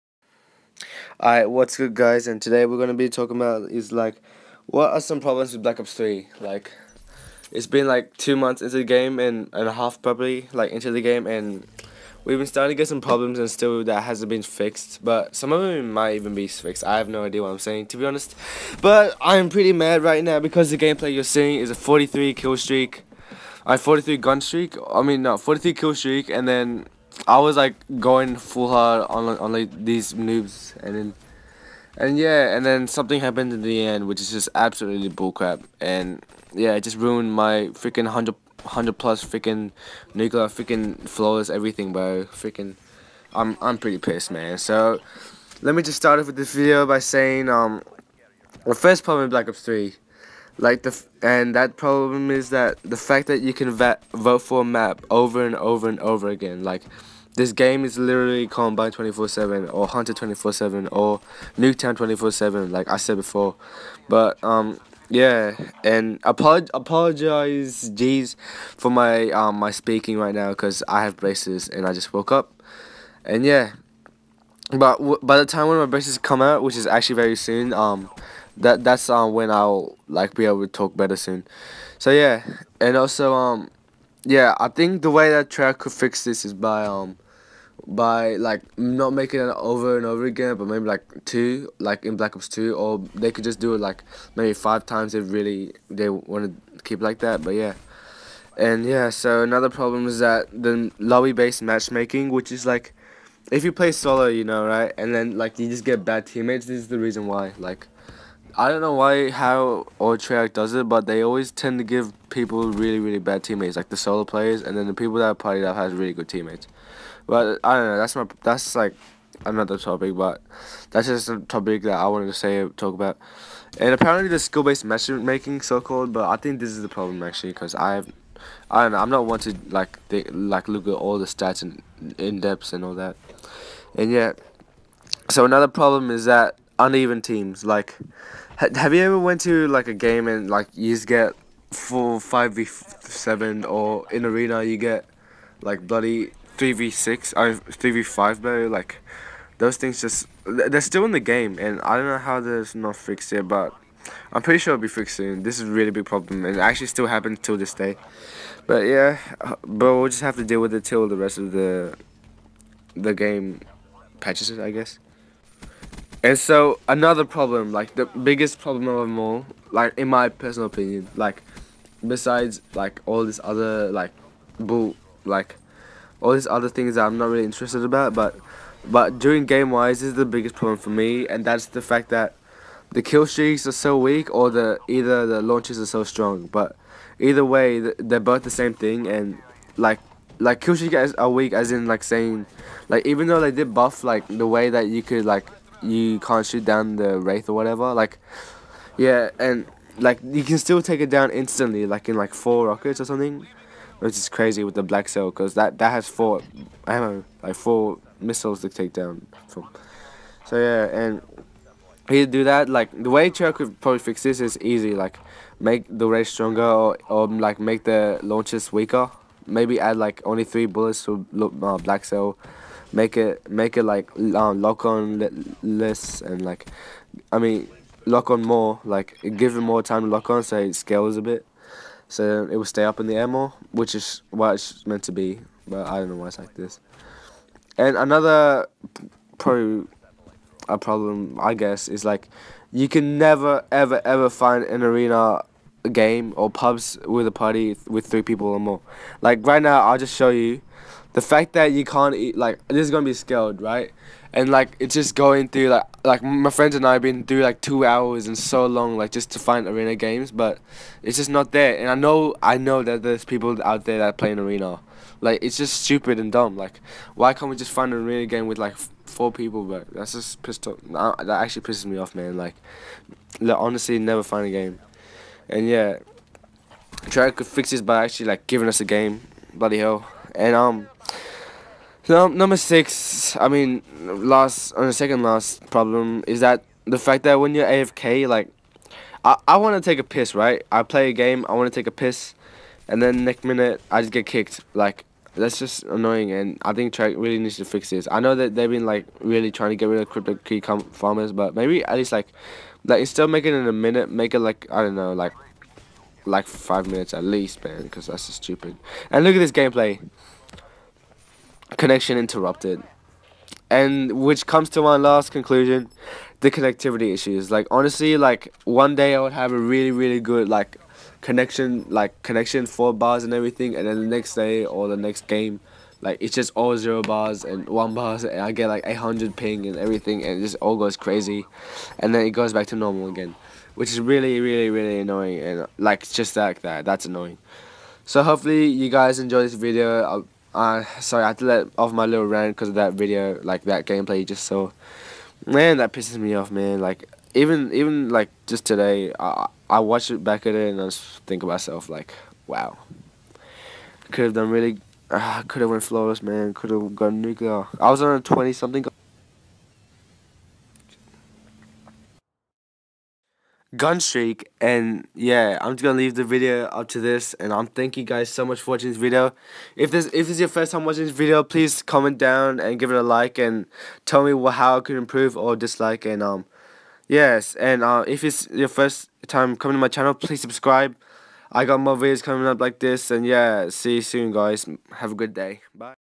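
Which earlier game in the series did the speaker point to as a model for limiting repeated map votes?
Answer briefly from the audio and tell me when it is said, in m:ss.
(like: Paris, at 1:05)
Black Ops Two, at 1:32.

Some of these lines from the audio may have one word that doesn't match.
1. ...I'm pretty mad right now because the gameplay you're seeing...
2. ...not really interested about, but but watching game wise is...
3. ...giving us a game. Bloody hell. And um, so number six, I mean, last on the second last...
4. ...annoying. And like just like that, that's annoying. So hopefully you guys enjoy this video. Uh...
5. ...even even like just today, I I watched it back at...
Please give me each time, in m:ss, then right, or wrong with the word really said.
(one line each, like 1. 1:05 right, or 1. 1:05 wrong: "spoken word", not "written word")
1. 0:19 right
2. 2:57 wrong: "during", not "watching"
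3. 4:38 right
4. 5:34 right
5. 5:47 right.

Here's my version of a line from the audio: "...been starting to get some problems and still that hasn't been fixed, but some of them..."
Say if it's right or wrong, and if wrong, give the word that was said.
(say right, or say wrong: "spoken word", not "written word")
right.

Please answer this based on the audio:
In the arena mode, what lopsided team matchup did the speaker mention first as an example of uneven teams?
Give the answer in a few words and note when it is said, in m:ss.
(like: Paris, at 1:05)
3 v 6, at 2:26.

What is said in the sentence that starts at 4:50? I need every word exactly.
I play a game, I want to take a piss, and then next minute I just get kicked.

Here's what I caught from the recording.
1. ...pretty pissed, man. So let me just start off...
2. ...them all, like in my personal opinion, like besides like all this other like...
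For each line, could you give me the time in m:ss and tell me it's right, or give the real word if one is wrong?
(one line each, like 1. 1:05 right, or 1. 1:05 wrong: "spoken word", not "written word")
1. 0:43 right
2. 2:49 right.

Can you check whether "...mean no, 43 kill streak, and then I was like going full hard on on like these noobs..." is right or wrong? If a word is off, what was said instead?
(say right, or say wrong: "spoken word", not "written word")
right.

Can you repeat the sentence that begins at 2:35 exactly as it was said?
This is a really big problem, and it actually still happens till this day.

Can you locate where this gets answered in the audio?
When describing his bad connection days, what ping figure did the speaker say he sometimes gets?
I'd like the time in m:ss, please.
5:28.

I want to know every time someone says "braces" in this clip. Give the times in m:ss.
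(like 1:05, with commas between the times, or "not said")
1:11, 1:15.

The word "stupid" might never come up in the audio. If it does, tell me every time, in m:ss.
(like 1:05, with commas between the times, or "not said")
4:25, 5:08.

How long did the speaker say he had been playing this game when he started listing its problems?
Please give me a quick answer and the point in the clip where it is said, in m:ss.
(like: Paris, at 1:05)
two months, at 0:08.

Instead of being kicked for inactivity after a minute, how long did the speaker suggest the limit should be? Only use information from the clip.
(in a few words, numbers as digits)
5 minutes.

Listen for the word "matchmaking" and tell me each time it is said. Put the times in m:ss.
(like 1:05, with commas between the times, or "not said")
1:41, 2:04.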